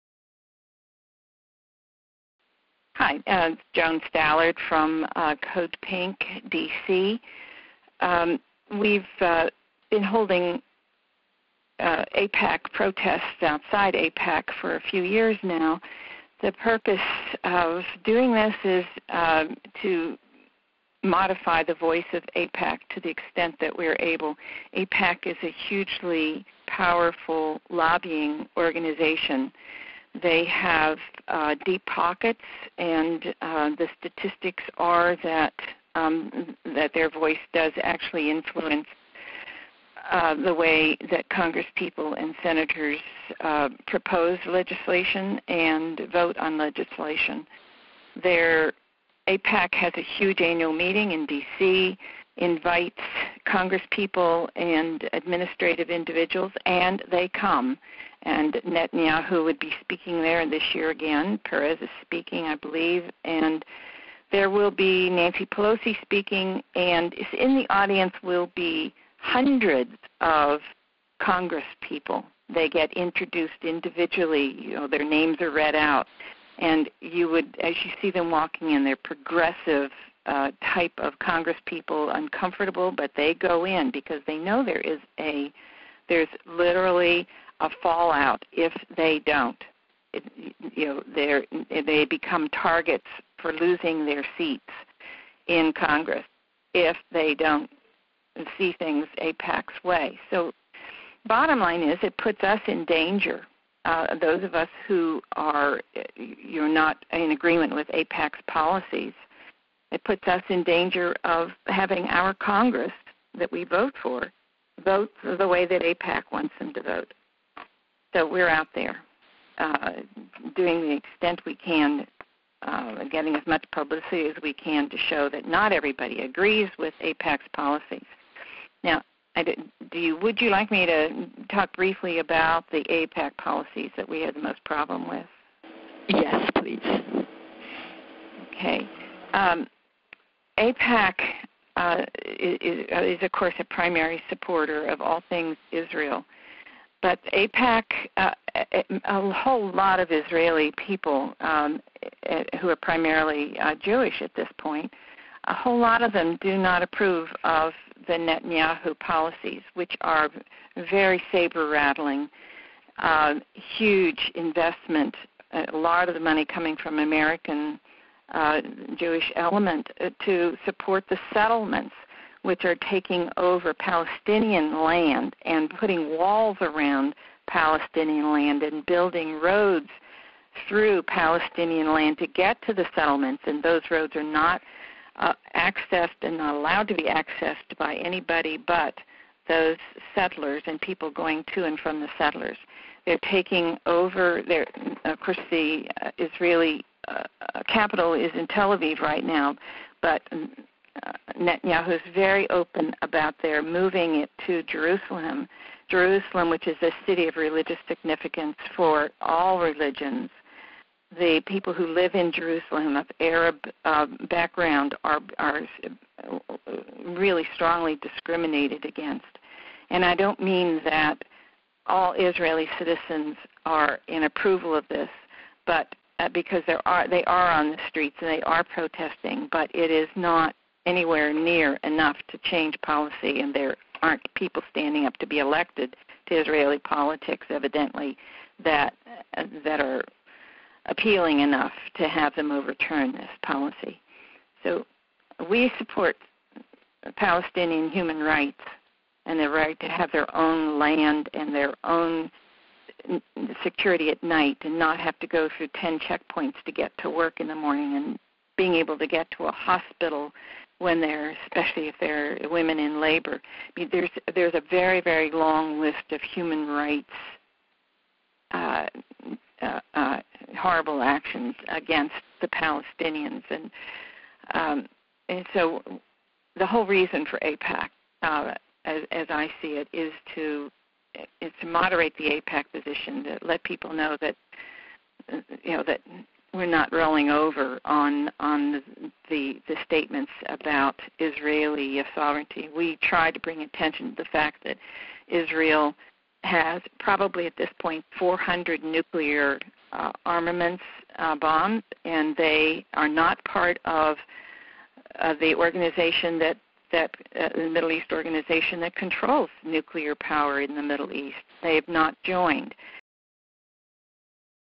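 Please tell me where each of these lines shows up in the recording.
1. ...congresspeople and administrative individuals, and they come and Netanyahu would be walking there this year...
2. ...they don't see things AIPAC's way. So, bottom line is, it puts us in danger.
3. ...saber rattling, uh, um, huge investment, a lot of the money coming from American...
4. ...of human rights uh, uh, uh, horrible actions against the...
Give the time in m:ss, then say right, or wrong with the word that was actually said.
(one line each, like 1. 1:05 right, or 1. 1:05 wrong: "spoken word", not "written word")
1. 0:53 wrong: "speaking", not "walking"
2. 1:37 right
3. 2:41 right
4. 4:26 right.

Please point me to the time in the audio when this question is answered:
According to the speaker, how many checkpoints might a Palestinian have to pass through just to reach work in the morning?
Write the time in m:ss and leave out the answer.
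4:15.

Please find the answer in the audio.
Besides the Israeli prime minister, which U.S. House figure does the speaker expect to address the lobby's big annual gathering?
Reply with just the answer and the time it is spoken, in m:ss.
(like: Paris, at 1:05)
Nancy Pelosi, at 1:05.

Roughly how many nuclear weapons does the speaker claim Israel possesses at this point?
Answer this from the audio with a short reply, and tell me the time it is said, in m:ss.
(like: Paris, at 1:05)
400, at 4:58.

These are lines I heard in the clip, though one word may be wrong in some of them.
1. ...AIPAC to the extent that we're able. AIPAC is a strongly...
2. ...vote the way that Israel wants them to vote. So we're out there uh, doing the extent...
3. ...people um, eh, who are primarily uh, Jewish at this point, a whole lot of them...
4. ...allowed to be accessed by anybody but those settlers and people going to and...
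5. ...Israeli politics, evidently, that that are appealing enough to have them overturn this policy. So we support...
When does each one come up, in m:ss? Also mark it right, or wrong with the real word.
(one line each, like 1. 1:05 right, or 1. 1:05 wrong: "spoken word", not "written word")
1. 0:22 wrong: "hugely", not "strongly"
2. 1:54 wrong: "AIPAC", not "Israel"
3. 2:30 right
4. 3:06 right
5. 3:56 right.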